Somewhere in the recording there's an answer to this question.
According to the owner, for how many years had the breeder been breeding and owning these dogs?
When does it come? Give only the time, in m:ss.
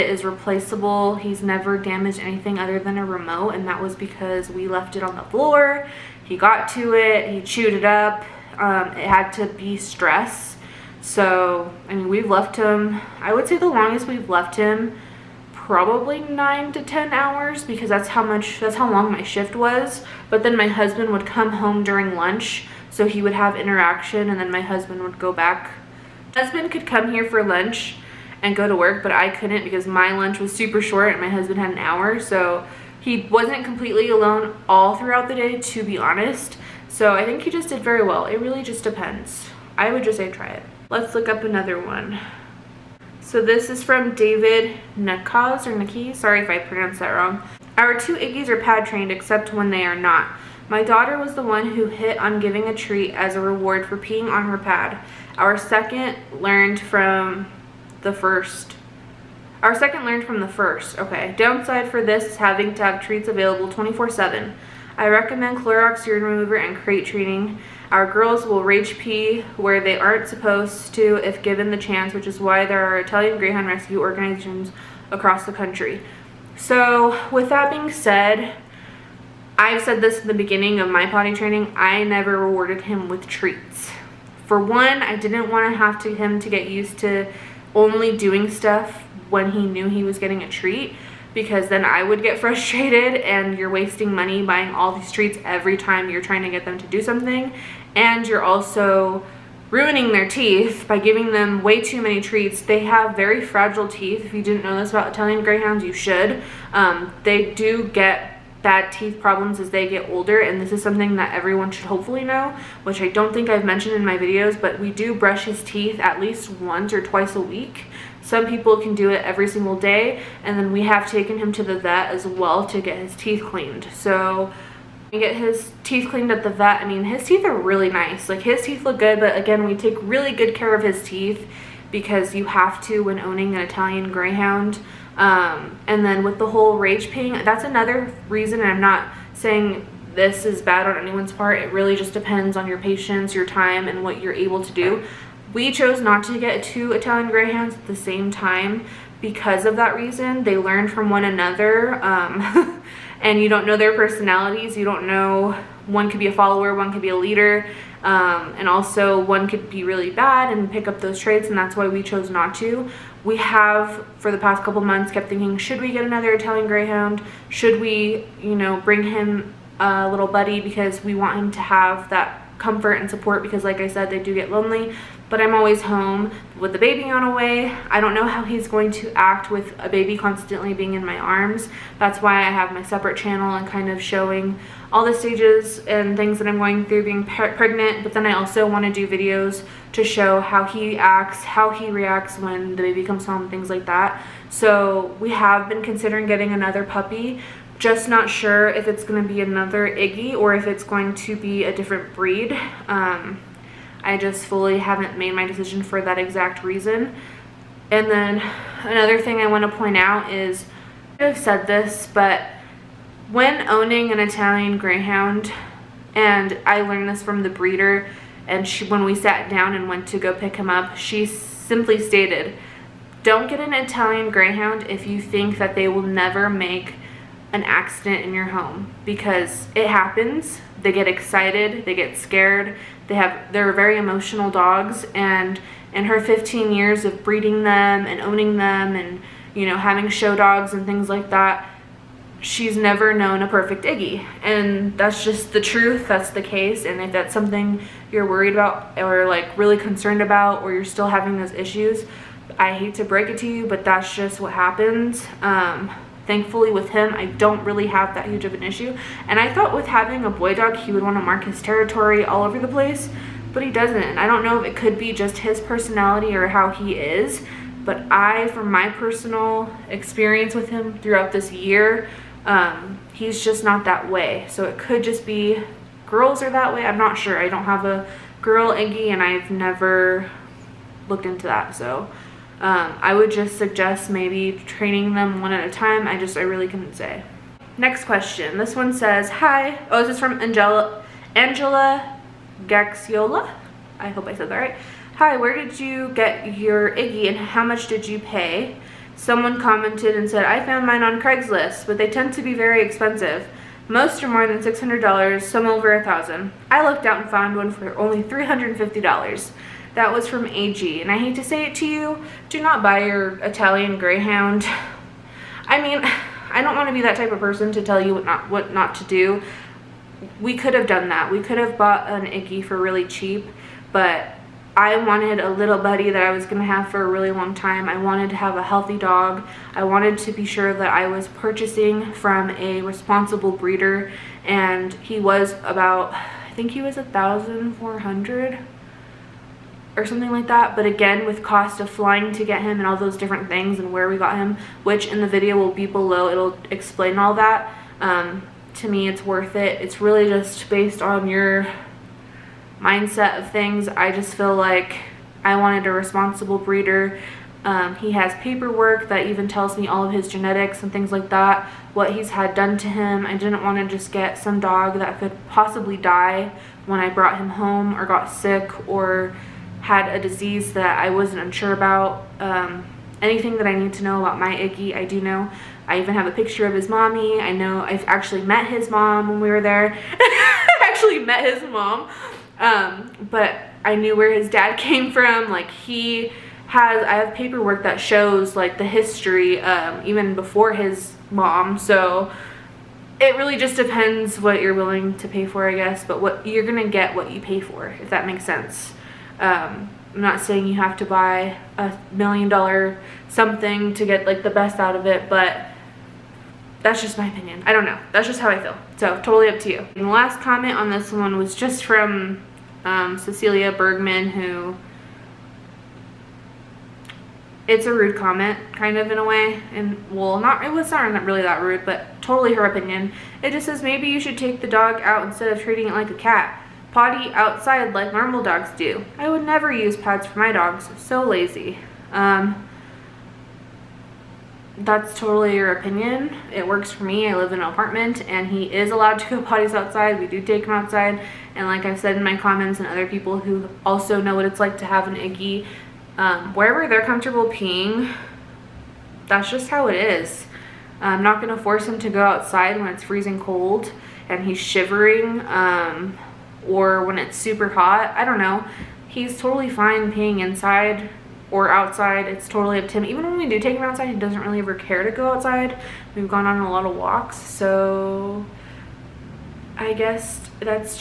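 3:56.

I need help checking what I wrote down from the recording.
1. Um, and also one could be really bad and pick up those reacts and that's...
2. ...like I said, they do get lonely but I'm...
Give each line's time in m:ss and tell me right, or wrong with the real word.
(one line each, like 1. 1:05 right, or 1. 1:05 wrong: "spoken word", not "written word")
1. 2:38 wrong: "traits", not "reacts"
2. 2:53 right.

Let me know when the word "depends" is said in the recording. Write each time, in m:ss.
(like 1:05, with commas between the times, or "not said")
0:38, 2:22, 6:33.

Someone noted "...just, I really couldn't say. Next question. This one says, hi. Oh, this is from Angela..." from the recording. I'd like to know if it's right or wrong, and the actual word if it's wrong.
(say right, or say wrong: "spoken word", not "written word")
right.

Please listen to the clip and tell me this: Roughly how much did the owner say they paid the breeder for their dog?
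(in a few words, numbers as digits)
1400.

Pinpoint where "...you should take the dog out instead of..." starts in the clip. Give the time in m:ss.
7:04.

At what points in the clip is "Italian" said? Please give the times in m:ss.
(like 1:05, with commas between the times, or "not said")
1:12, 1:45, 2:13, 2:26, 2:46, 3:34, 3:43, 5:13.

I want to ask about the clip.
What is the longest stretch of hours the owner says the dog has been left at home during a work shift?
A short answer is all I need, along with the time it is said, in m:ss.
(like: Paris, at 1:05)
9 to 10 hours, at 0:16.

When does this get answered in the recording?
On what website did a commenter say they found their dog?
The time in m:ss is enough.
5:01.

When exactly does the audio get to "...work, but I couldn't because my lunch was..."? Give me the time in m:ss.
0:28.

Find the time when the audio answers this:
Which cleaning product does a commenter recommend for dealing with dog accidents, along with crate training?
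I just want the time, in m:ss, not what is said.
1:05.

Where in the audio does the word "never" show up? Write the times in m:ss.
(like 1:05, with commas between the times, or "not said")
0:01, 1:22, 3:46, 4:02, 4:39, 7:09.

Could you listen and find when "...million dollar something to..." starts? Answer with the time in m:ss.
6:42.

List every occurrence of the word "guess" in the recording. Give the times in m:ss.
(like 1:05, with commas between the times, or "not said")
6:35, 7:49.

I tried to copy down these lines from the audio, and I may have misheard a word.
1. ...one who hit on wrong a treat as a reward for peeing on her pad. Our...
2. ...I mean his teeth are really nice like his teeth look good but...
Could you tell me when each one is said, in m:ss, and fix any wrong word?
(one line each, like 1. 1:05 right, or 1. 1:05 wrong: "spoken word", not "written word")
1. 0:51 wrong: "giving", not "wrong"
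2. 2:06 right.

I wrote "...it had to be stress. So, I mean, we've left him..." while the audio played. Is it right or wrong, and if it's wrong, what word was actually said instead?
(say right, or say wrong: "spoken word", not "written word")
right.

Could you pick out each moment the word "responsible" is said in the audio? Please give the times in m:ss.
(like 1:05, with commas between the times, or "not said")
5:32, 5:55.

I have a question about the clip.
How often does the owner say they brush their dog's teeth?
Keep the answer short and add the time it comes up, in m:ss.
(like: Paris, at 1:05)
Once or twice a week, at 1:56.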